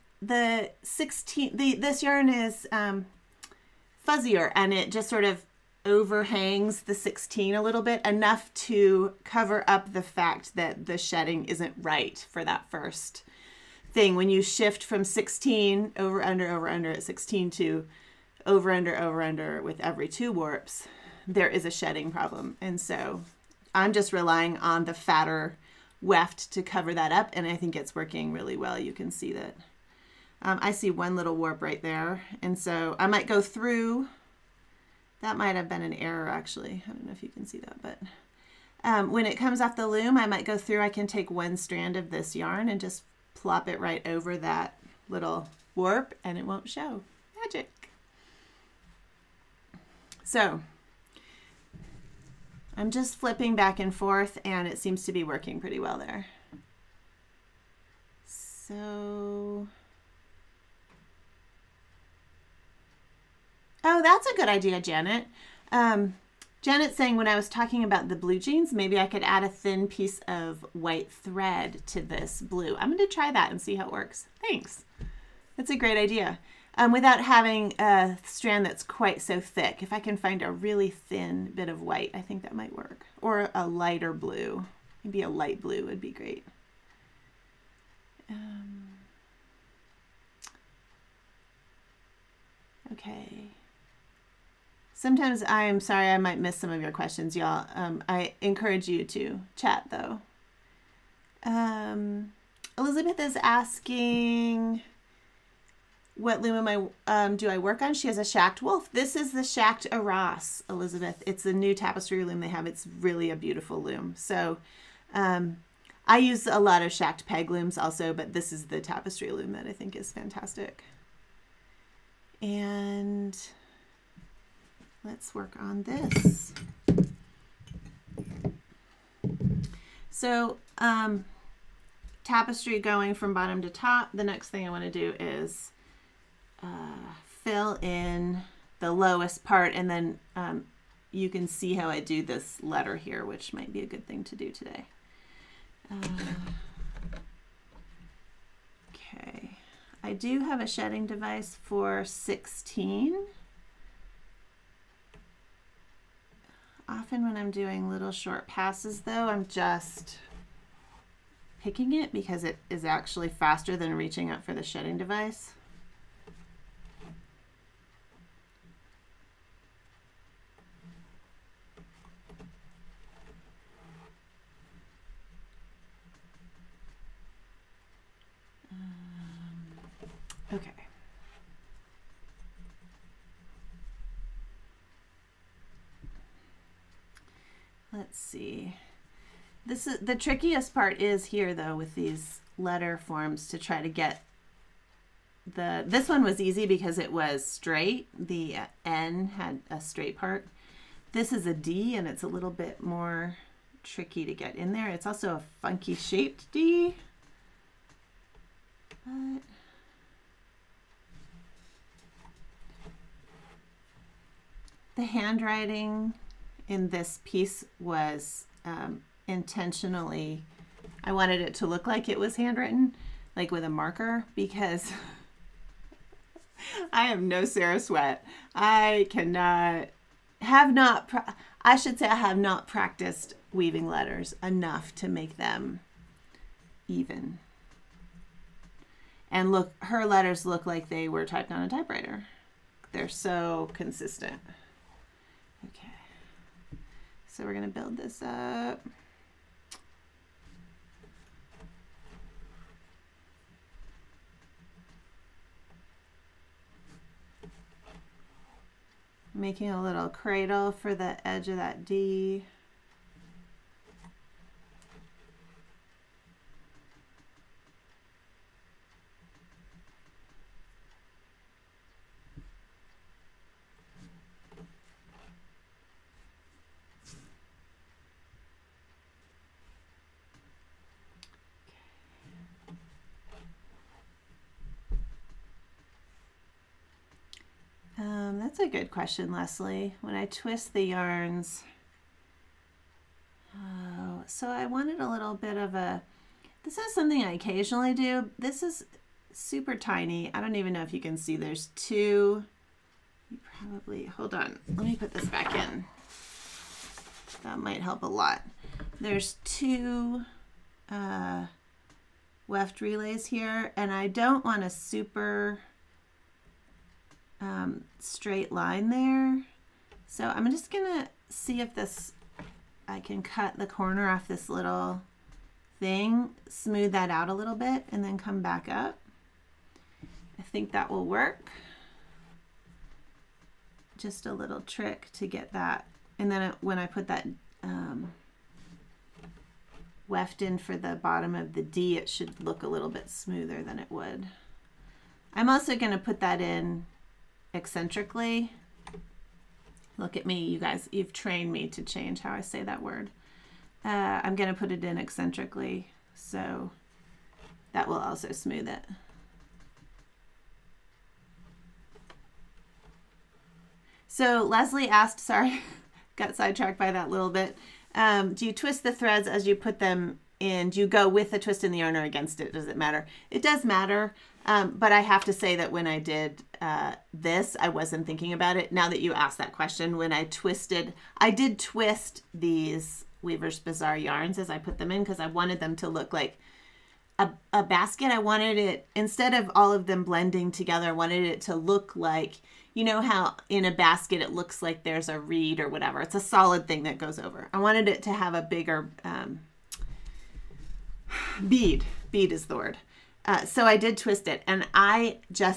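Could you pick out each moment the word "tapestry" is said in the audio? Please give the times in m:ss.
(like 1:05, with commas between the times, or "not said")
1:51, 1:58, 2:12.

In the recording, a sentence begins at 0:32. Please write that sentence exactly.
And so I might go through, that might have been an error actually.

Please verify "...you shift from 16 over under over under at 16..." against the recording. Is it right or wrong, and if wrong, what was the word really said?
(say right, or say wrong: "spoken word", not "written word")
right.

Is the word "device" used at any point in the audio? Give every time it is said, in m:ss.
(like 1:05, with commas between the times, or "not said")
2:31, 2:44.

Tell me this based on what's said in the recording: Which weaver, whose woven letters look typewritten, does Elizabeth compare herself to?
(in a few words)
Sarah Swett.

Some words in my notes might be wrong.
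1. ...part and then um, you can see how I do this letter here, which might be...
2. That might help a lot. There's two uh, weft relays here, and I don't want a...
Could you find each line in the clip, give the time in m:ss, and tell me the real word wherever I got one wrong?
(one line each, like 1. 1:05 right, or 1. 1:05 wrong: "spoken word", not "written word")
1. 2:19 right
2. 5:07 right.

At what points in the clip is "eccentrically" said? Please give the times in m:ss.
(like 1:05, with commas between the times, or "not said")
5:47, 5:54.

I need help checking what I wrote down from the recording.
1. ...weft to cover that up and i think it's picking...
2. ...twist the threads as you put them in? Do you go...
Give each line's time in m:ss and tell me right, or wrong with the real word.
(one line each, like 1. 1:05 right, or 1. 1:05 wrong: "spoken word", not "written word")
1. 0:25 wrong: "working", not "picking"
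2. 6:08 right.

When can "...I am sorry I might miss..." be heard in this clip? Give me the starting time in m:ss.
1:35.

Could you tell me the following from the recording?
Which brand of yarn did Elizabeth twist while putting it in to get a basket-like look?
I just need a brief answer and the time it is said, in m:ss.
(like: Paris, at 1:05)
Weaver's Bazaar, at 6:23.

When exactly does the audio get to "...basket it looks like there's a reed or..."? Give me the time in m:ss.
6:33.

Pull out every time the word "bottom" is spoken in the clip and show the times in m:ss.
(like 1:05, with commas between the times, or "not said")
2:13, 5:40.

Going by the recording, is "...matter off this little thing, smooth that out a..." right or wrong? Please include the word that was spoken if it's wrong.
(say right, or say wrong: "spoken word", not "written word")
wrong: "corner", not "matter".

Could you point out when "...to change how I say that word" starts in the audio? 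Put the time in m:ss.
5:51.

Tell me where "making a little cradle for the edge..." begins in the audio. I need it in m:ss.
4:19.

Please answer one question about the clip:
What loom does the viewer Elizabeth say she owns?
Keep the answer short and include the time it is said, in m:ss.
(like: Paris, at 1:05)
Schacht Wolf, at 1:48.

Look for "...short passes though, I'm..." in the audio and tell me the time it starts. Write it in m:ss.
2:38.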